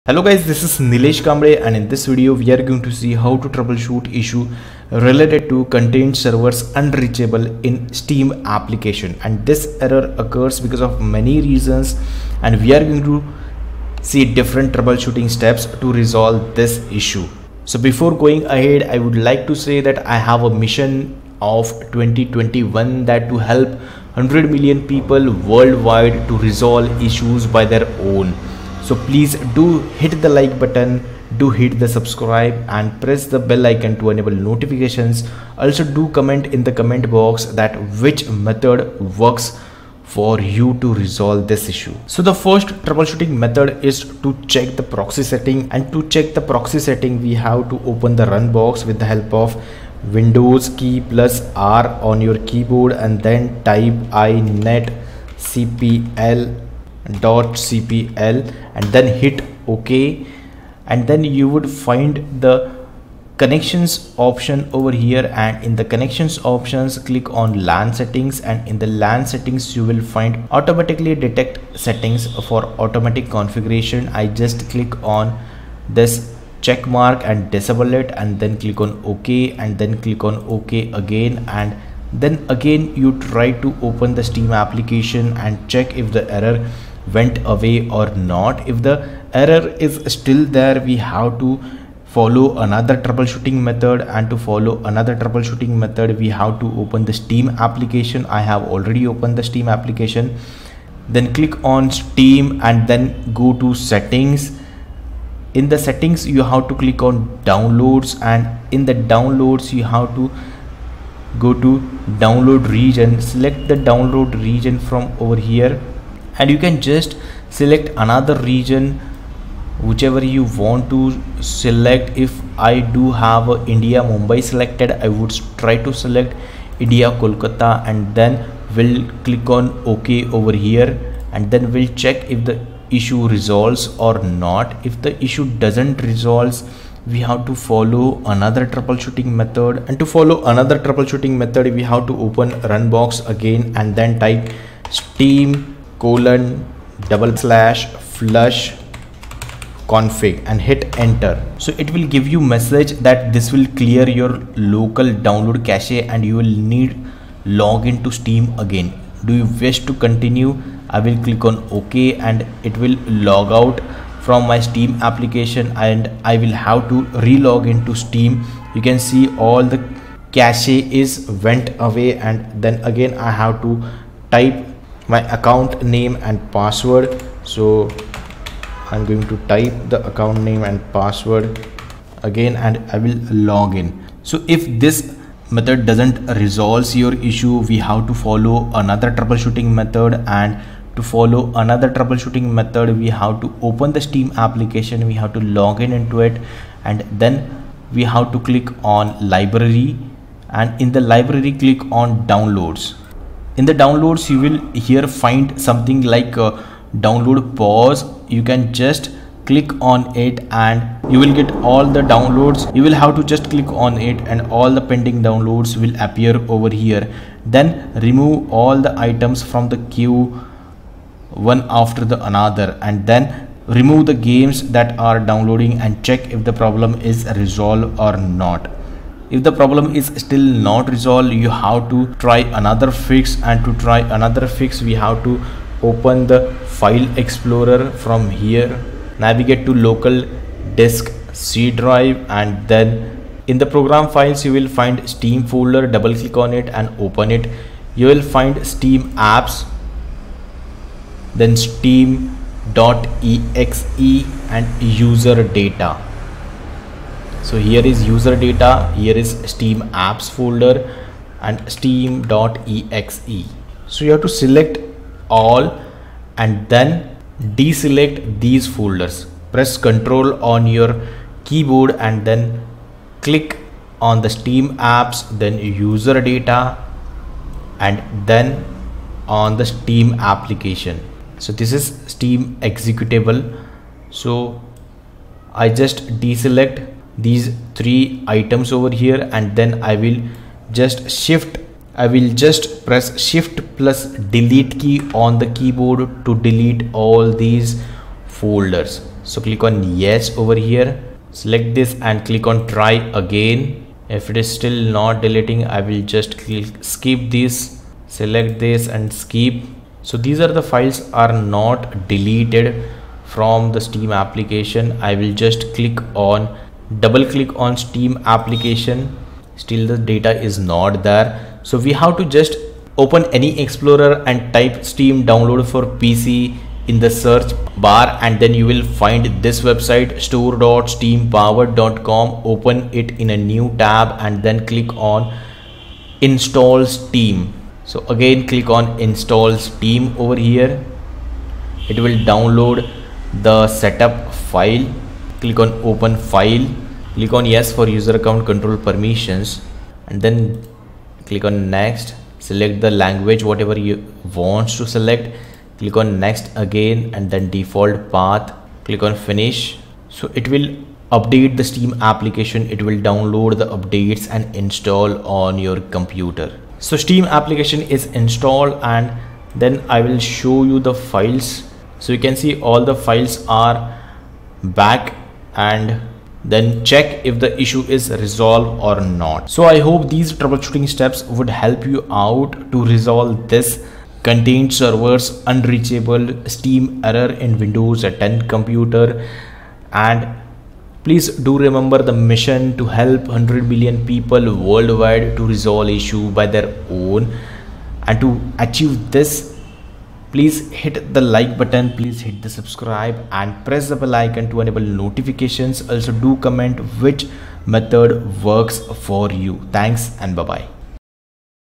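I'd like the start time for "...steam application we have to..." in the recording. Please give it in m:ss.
3:14.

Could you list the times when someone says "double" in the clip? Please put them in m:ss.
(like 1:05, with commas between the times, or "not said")
2:27, 4:05, 5:16.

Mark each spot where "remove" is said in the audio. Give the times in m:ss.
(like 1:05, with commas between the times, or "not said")
3:38, 3:43.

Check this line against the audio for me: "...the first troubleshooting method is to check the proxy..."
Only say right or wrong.
right.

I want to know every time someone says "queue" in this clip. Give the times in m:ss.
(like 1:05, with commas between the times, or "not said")
3:39.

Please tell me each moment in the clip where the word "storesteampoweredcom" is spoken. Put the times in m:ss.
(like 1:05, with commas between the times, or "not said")
5:30.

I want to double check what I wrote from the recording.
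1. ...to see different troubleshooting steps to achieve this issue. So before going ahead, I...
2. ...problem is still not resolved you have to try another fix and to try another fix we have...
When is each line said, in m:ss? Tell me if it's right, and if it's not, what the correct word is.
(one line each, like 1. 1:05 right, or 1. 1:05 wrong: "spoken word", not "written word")
1. 0:13 wrong: "resolve", not "achieve"
2. 3:49 right.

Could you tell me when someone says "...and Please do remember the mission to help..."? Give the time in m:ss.
6:29.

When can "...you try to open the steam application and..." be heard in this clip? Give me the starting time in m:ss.
1:22.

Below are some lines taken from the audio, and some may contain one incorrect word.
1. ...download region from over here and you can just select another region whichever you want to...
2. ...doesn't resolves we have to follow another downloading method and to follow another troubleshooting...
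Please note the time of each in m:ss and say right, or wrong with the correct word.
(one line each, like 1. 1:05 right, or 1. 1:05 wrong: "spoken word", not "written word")
1. 1:53 right
2. 2:15 wrong: "troubleshooting", not "downloading".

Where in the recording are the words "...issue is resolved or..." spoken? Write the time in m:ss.
6:17.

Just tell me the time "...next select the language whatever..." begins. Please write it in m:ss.
5:51.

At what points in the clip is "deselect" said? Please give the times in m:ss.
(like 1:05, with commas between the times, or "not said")
4:27, 4:46.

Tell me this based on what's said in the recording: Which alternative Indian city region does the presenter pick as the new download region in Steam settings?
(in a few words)
Kolkata.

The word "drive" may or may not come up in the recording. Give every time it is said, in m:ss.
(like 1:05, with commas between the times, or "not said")
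4:01.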